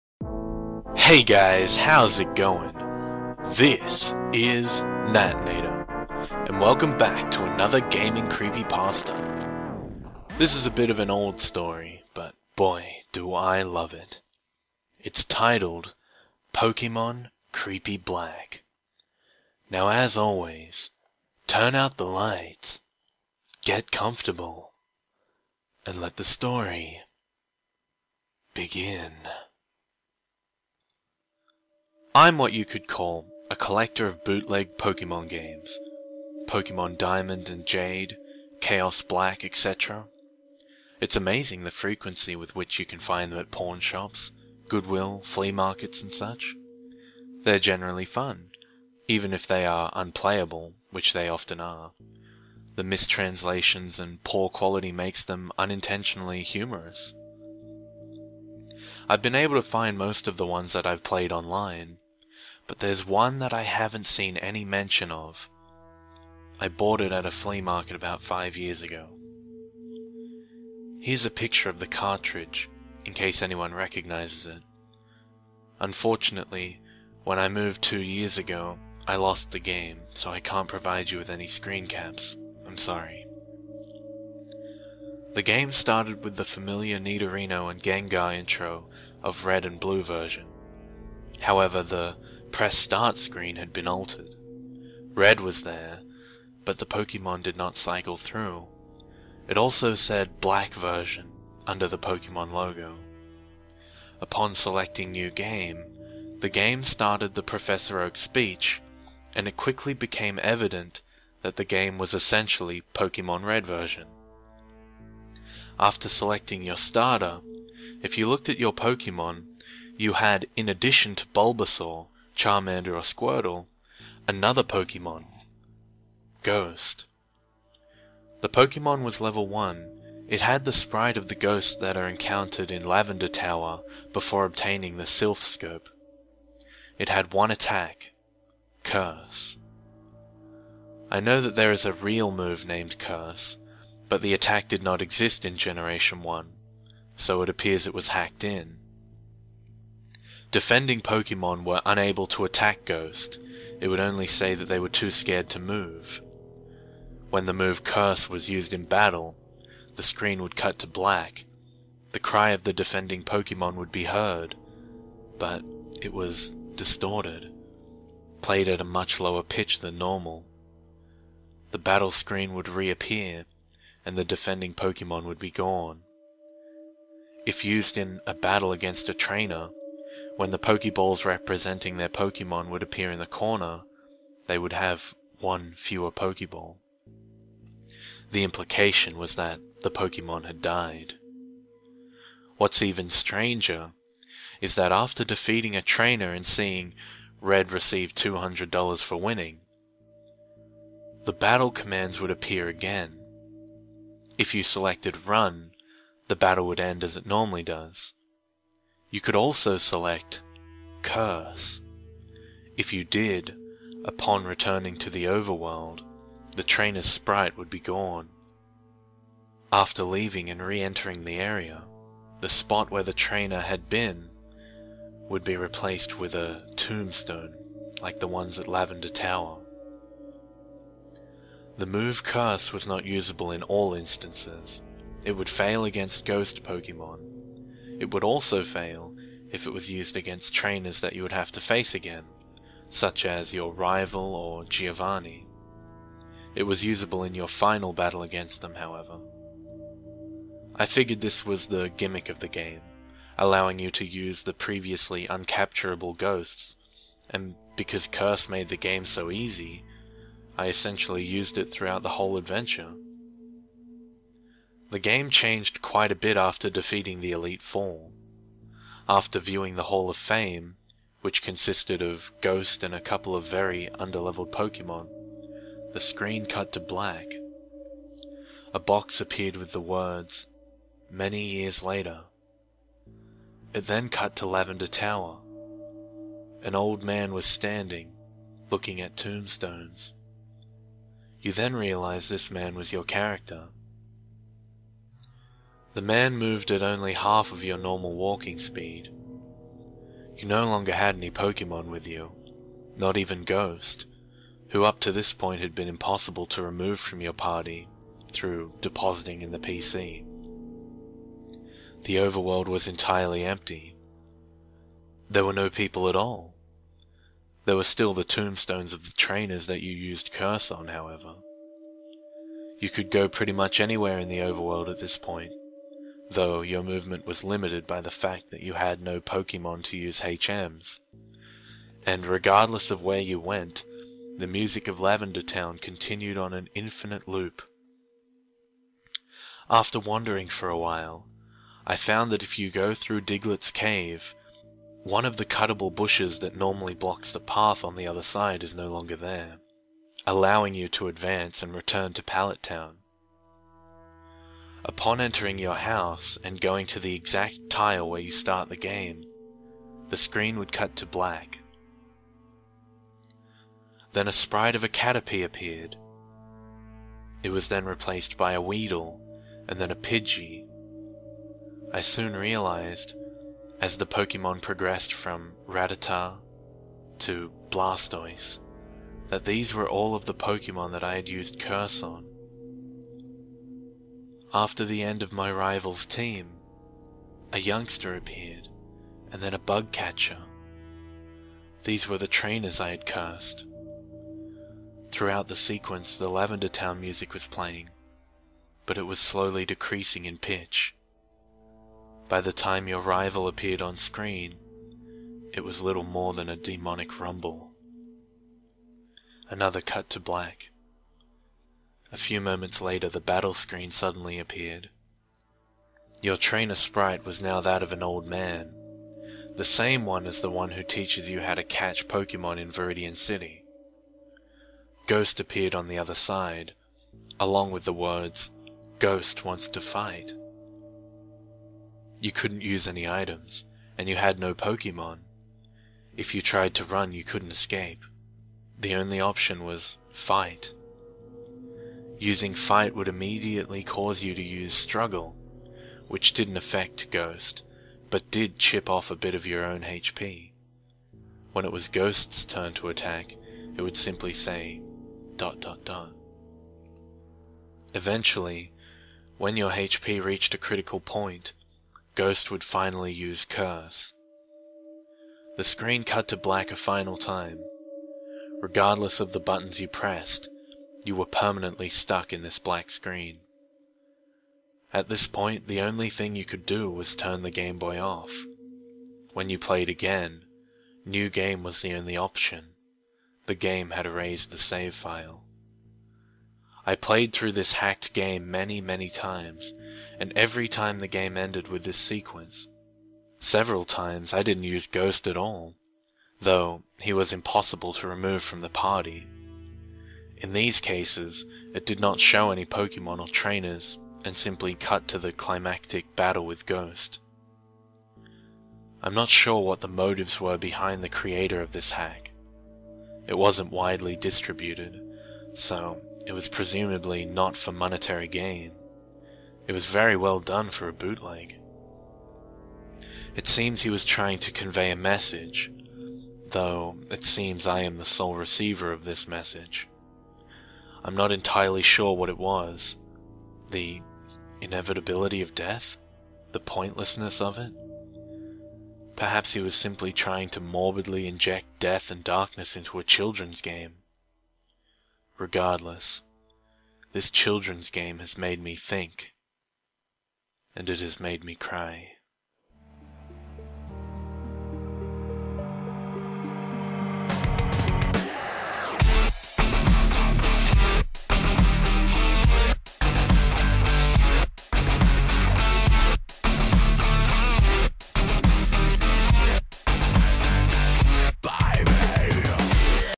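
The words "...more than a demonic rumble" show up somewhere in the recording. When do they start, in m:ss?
6:46.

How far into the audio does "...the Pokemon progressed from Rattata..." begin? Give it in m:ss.
6:13.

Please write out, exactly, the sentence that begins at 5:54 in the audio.
Upon entering your house and going to the exact tile where you start the game, the screen would cut to black.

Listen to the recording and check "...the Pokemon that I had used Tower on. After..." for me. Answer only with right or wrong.
wrong.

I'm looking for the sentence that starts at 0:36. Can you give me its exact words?
Pokemon Diamond and Jade, Chaos Black, etc.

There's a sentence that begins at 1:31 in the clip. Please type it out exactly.
However, the press start screen had been altered.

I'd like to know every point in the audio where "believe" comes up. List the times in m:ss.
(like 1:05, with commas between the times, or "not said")
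not said.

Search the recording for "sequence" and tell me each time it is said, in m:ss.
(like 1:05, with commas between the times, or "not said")
6:35, 8:11.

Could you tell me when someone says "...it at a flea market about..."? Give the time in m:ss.
1:07.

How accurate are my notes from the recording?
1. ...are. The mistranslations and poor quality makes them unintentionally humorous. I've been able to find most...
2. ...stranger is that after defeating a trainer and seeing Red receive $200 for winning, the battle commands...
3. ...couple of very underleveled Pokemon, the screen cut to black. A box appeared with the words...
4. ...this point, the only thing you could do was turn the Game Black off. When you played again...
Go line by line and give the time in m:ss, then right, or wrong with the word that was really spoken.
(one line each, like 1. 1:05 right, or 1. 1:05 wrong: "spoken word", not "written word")
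1. 0:51 right
2. 3:13 right
3. 4:32 right
4. 7:55 wrong: "Boy", not "Black".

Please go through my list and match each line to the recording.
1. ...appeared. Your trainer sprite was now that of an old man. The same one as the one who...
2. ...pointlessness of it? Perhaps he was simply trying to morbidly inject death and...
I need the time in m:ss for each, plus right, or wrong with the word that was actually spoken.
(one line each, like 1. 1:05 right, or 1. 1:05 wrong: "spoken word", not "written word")
1. 6:54 right
2. 8:56 right.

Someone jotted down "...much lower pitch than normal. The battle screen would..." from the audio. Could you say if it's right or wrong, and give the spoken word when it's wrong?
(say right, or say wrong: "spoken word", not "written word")
right.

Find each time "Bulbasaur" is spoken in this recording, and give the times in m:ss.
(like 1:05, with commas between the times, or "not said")
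2:01.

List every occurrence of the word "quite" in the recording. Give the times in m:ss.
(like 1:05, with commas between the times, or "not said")
4:25.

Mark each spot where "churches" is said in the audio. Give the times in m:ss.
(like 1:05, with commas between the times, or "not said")
not said.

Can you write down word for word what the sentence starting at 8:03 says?
The game had erased the save file.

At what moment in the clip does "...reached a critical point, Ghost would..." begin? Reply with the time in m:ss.
7:40.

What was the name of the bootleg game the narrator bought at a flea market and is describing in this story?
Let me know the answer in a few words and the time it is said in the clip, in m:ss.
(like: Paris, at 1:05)
Pokemon Creepy Black, at 0:16.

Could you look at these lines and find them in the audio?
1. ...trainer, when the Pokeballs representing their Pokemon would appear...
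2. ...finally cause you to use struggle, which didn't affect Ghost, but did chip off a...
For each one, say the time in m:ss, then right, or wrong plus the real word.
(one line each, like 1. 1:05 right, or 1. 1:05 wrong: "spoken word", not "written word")
1. 2:59 right
2. 7:23 wrong: "immediately", not "finally".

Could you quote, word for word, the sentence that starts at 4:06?
It was usable in your final battle against them, however.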